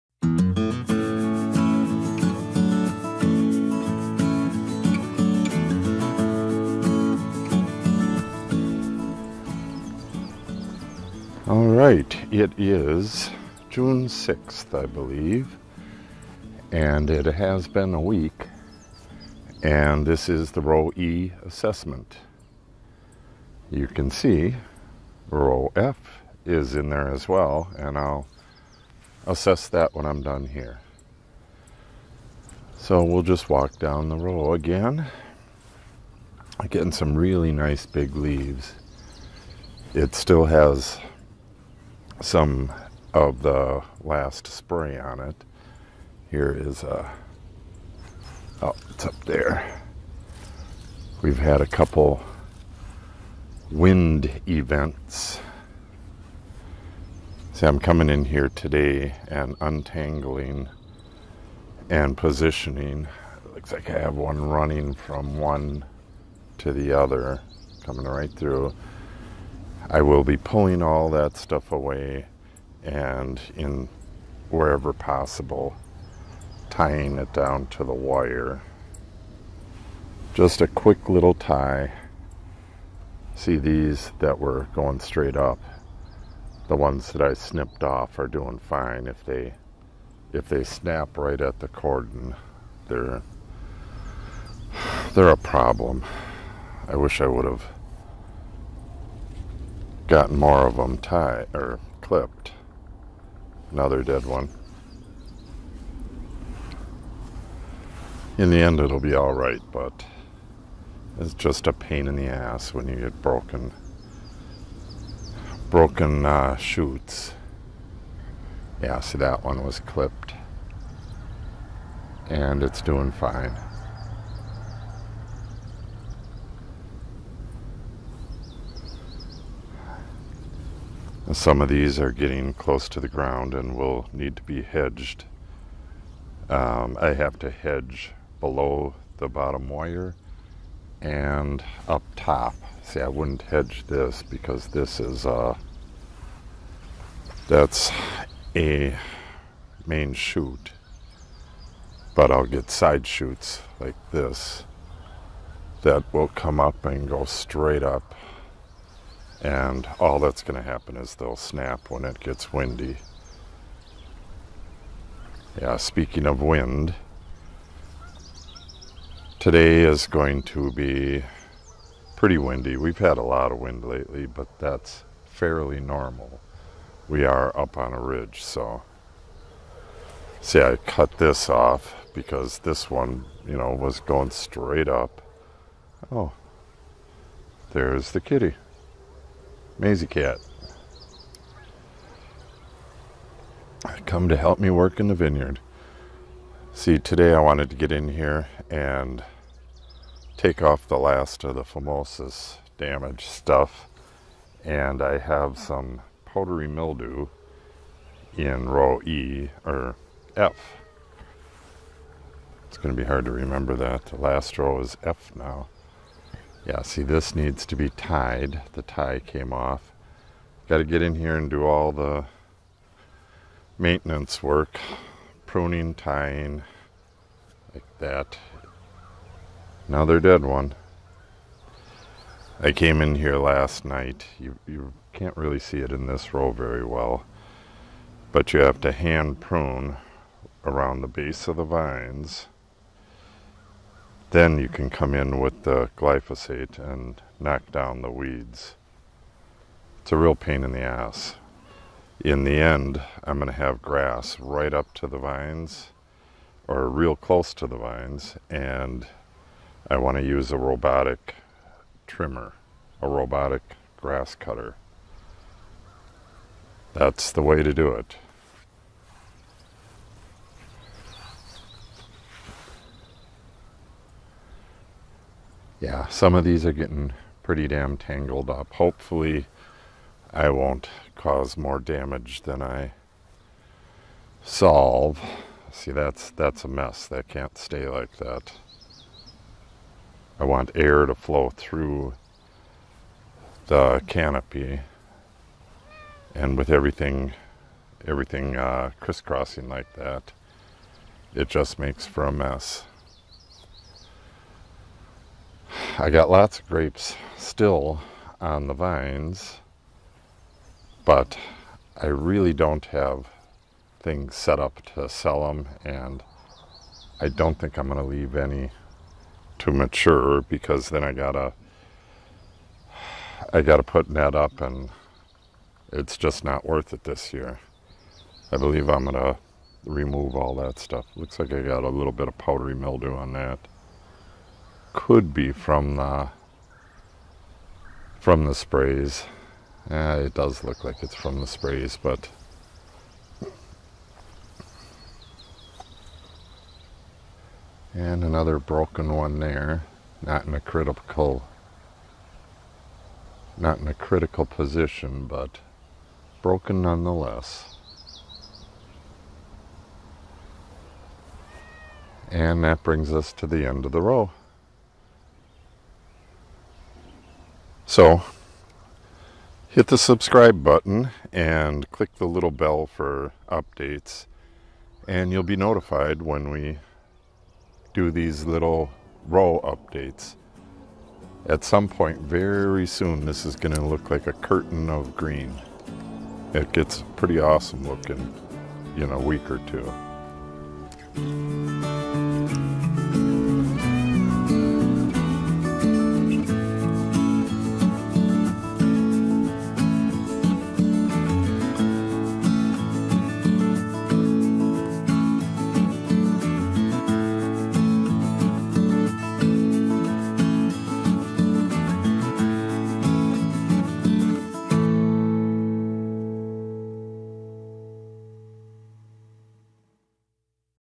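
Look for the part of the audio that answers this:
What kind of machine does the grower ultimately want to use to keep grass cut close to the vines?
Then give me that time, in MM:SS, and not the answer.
04:23.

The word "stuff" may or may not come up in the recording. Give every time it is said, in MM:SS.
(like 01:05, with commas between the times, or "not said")
01:11, 03:23, 05:30.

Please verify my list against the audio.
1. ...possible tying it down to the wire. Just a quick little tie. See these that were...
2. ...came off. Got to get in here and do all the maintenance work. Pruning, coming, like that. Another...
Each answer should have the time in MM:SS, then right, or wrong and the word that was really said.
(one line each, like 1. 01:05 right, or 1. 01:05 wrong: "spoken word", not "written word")
1. 01:14 right
2. 03:39 wrong: "tying", not "coming".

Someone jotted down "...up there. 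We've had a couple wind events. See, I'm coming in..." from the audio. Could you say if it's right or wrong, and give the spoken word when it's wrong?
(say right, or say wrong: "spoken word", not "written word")
right.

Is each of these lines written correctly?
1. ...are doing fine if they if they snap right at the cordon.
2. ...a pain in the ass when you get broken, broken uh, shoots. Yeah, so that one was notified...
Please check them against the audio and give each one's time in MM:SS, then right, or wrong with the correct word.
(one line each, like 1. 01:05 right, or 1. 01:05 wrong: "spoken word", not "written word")
1. 01:28 right
2. 01:51 wrong: "clipped", not "notified".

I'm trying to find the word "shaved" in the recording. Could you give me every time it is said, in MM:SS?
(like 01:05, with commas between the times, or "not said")
not said.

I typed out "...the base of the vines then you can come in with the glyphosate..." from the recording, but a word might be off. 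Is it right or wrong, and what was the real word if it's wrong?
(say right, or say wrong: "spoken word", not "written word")
right.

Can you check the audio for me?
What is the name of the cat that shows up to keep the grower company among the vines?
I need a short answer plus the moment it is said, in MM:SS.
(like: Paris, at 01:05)
Maisie, at 03:09.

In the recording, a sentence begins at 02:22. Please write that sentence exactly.
See, I wouldn't hedge this because this is a.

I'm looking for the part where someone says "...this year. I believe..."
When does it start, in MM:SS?
05:27.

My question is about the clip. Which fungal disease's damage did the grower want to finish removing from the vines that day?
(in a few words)
Phomopsis.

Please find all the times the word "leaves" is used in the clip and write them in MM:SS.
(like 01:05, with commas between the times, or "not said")
00:38, 05:18.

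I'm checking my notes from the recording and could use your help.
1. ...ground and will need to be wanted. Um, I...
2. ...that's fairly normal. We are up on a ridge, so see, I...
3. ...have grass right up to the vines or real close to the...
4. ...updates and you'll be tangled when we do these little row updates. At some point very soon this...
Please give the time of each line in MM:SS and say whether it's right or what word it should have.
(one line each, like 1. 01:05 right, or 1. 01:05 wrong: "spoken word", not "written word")
1. 02:13 wrong: "hedged", not "wanted"
2. 02:54 right
3. 04:13 right
4. 06:13 wrong: "notified", not "tangled".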